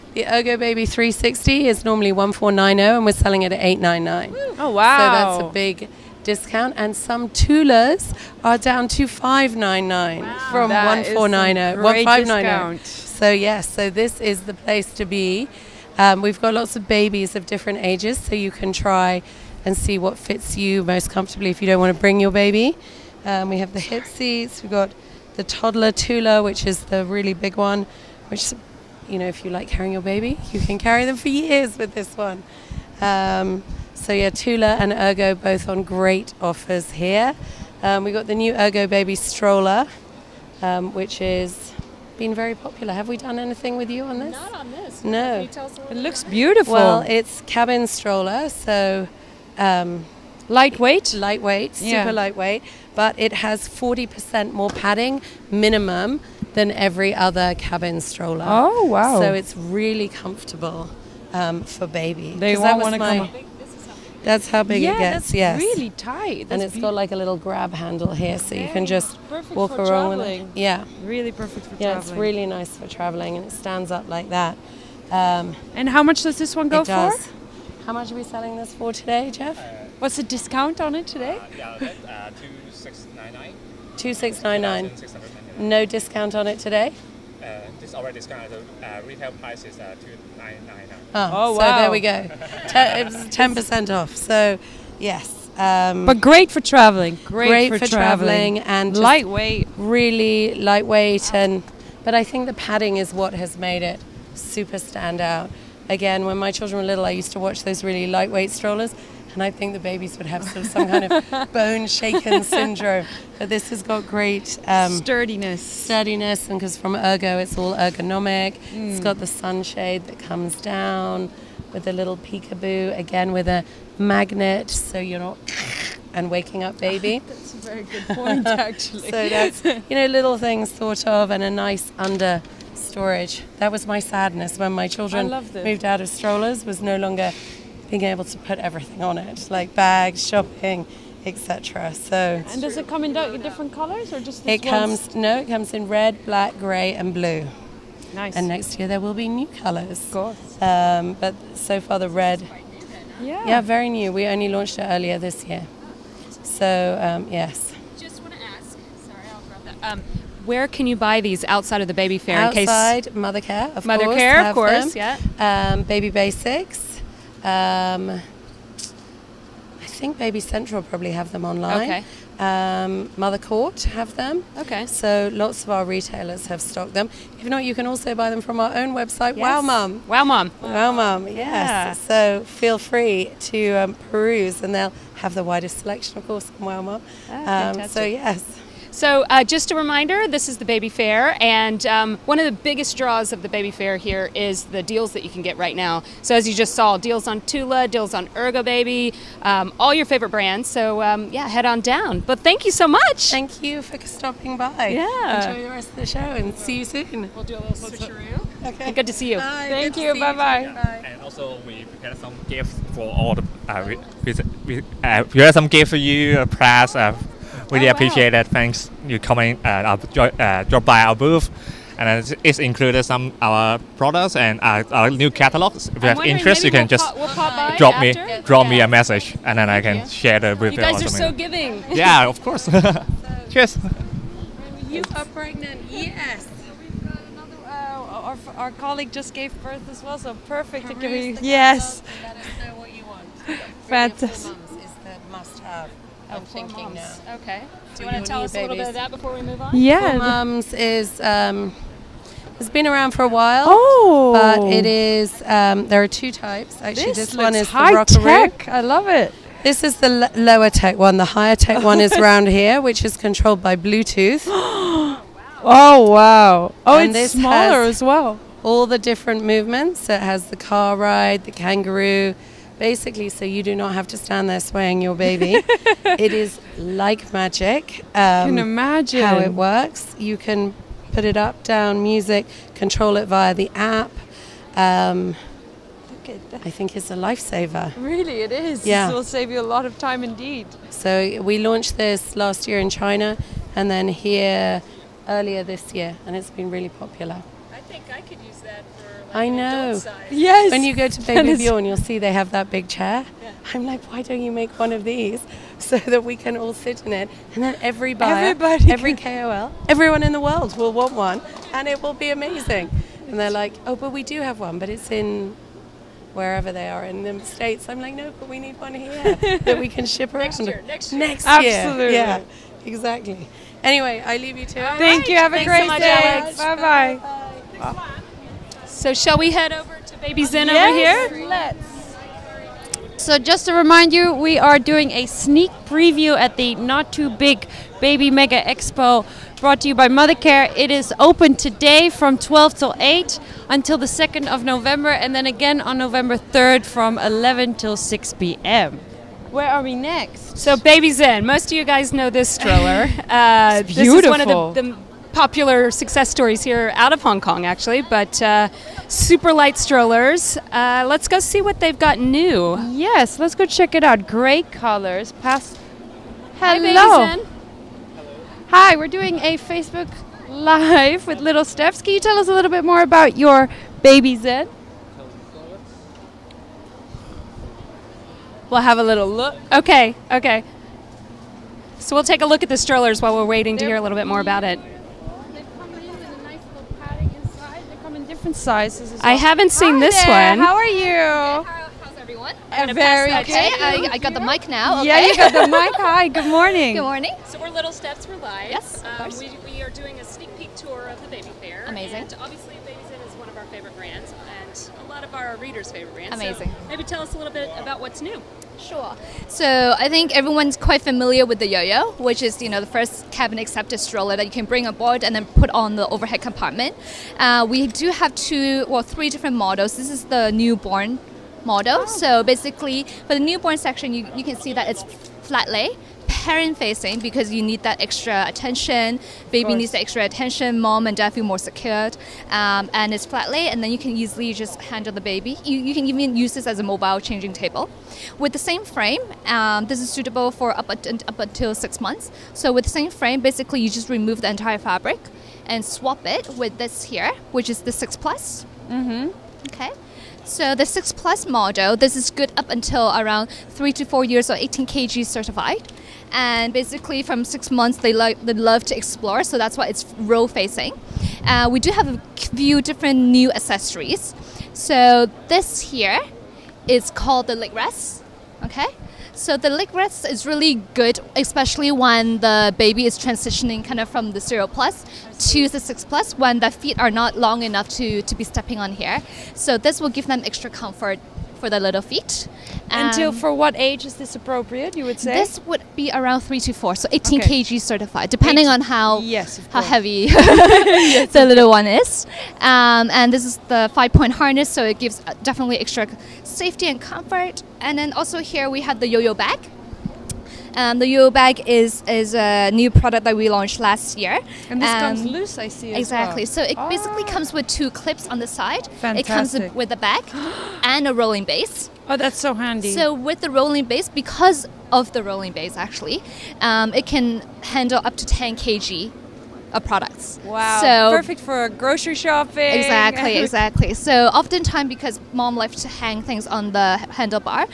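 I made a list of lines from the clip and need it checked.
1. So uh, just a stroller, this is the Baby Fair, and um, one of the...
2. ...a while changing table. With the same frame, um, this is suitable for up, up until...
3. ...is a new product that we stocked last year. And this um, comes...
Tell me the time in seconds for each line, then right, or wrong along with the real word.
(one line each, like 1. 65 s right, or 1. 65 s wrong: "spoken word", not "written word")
1. 188 s wrong: "reminder", not "stroller"
2. 436 s wrong: "mobile", not "while"
3. 502 s wrong: "launched", not "stocked".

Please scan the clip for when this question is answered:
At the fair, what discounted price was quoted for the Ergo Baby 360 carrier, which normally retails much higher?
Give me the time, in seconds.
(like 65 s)
3 s.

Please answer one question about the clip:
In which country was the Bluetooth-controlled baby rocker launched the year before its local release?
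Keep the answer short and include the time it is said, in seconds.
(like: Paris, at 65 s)
China, at 292 s.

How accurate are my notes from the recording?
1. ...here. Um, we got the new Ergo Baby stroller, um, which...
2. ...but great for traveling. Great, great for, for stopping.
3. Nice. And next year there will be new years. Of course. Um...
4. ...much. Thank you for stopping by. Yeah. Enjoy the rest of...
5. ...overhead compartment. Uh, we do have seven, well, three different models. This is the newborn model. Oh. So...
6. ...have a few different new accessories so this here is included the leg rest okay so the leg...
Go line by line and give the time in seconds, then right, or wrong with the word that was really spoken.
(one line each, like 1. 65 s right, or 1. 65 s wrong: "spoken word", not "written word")
1. 36 s right
2. 96 s wrong: "traveling", not "stopping"
3. 148 s wrong: "colours", not "years"
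4. 202 s right
5. 416 s wrong: "two", not "seven"
6. 461 s wrong: "called", not "included".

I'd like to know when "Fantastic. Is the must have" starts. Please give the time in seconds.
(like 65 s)
243 s.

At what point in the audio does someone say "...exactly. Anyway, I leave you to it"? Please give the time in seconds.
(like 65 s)
322 s.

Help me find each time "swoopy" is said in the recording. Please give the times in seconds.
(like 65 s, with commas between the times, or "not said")
not said.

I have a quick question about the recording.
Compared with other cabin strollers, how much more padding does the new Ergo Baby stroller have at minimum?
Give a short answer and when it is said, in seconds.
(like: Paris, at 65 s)
40%, at 53 s.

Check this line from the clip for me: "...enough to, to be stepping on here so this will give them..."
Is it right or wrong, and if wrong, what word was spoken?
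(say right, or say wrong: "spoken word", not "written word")
right.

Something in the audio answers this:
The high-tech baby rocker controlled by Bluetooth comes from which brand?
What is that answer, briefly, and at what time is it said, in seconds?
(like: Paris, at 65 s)
Four Moms, at 250 s.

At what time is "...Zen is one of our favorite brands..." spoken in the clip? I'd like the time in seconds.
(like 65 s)
403 s.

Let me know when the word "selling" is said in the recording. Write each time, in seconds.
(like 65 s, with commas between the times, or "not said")
3 s, 78 s.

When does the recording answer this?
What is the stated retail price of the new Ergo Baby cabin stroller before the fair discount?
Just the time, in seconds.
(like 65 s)
90 s.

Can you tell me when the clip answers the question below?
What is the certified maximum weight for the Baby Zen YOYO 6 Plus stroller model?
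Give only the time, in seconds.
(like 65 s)
454 s.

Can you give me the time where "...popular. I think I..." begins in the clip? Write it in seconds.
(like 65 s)
296 s.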